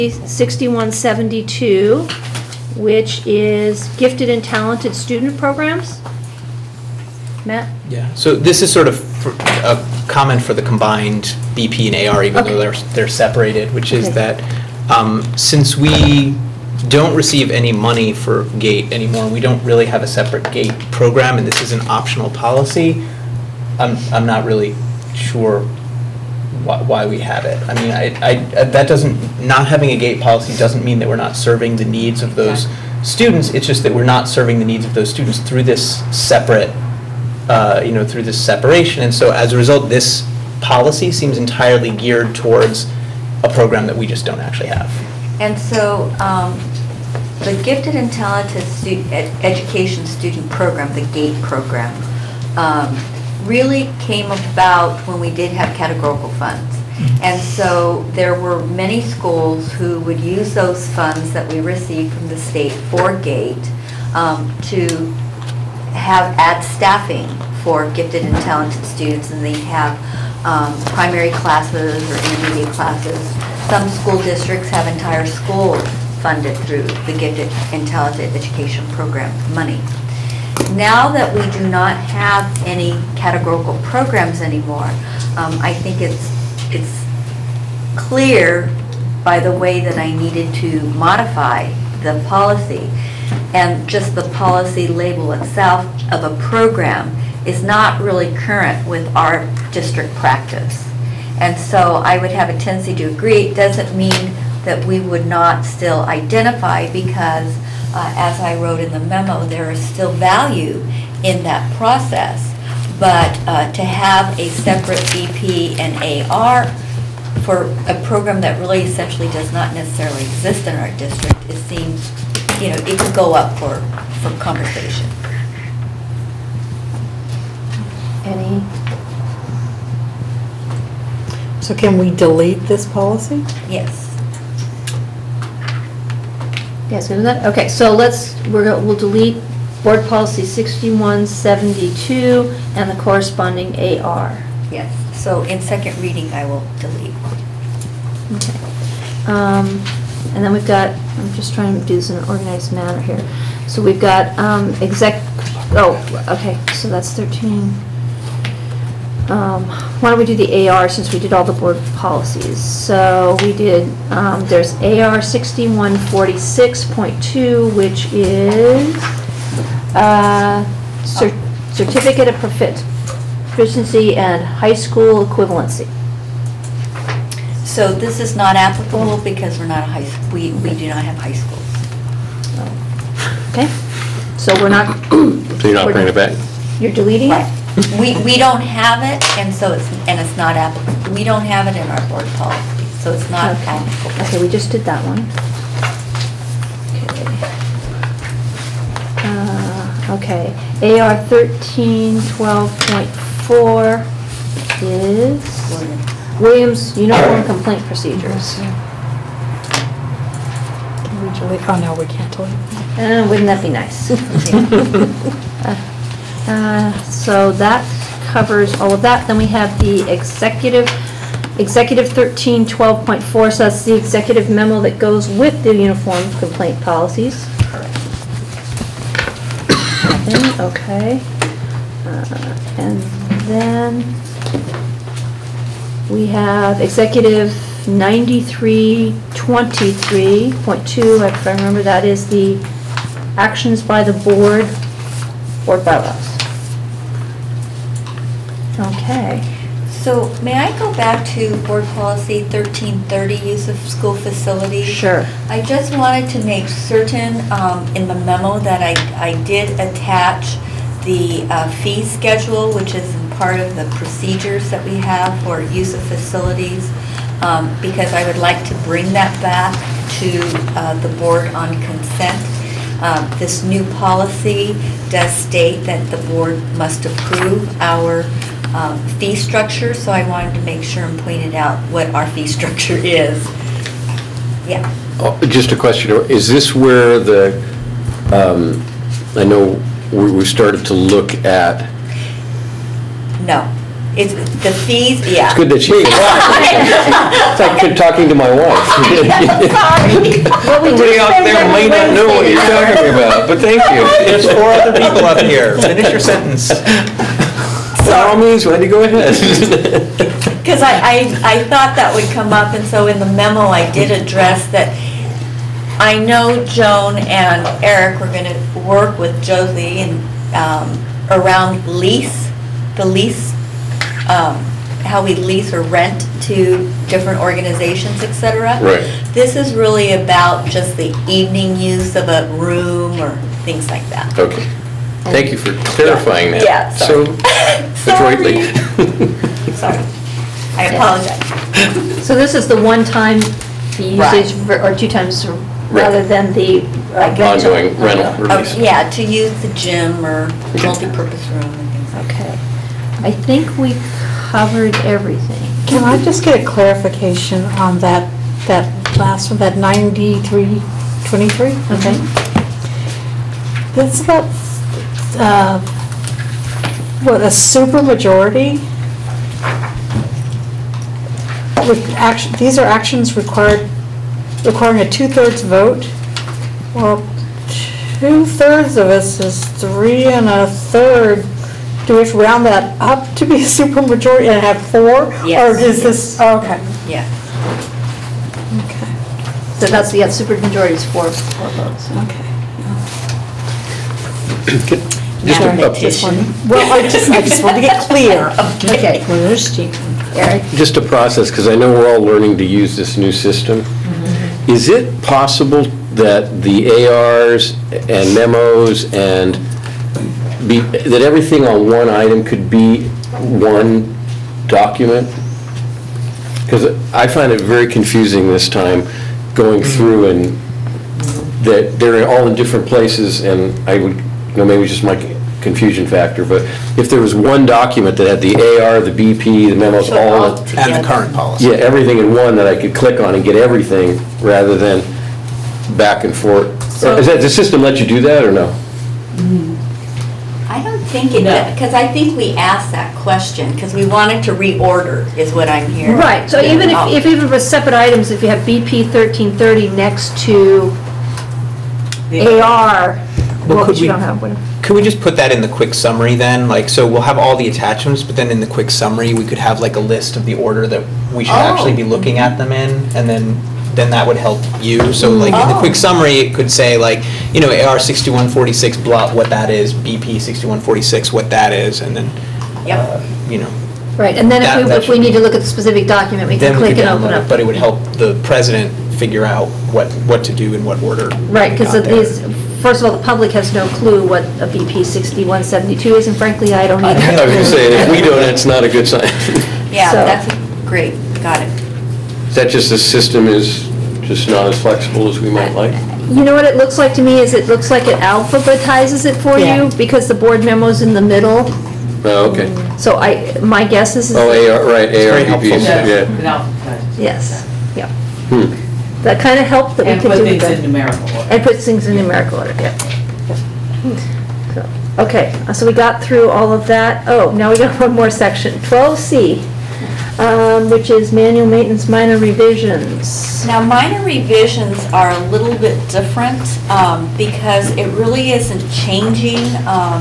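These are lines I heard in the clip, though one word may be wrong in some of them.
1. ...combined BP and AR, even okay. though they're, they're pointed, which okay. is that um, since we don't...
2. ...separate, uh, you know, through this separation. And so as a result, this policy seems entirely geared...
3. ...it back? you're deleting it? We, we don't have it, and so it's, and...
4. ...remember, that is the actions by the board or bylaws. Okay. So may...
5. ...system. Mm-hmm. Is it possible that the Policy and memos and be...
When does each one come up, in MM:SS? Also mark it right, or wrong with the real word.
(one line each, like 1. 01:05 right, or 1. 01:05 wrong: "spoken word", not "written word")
1. 00:10 wrong: "separated", not "pointed"
2. 00:36 right
3. 03:06 right
4. 04:01 right
5. 06:43 wrong: "ARs", not "Policy".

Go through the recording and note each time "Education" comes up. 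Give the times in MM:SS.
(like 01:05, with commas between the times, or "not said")
00:49, 01:18.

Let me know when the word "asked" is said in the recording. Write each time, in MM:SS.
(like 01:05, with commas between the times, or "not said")
07:22.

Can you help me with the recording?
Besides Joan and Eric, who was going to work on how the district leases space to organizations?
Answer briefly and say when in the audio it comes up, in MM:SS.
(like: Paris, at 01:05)
Josie, at 05:19.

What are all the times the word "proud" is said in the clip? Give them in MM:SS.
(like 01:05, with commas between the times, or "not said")
not said.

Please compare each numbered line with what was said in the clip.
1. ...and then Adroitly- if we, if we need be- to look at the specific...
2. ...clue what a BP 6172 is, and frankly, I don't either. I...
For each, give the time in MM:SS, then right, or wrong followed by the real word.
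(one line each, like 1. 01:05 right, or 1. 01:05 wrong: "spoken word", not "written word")
1. 07:54 wrong: "That", not "Adroitly"
2. 08:03 right.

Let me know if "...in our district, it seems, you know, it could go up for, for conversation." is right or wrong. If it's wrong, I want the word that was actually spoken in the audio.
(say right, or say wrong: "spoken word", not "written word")
right.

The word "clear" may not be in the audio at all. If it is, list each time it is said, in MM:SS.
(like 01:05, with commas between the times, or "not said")
01:28, 06:38.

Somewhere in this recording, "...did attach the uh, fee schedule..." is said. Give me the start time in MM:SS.
04:19.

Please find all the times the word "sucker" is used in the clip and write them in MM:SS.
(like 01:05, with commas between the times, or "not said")
not said.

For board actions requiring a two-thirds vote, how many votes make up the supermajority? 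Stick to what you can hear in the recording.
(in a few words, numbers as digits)
4.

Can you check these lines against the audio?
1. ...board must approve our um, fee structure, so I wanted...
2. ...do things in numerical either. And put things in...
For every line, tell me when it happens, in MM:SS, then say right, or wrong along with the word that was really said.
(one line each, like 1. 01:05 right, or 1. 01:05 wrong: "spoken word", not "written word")
1. 04:36 right
2. 08:30 wrong: "order", not "either".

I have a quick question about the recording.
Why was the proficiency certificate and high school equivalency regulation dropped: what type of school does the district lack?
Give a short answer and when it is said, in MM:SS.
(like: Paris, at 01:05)
high schools, at 03:01.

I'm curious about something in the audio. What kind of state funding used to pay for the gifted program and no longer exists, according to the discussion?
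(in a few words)
categorical funds.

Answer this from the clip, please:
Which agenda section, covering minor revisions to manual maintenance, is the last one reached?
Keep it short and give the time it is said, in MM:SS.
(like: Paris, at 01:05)
12C, at 08:38.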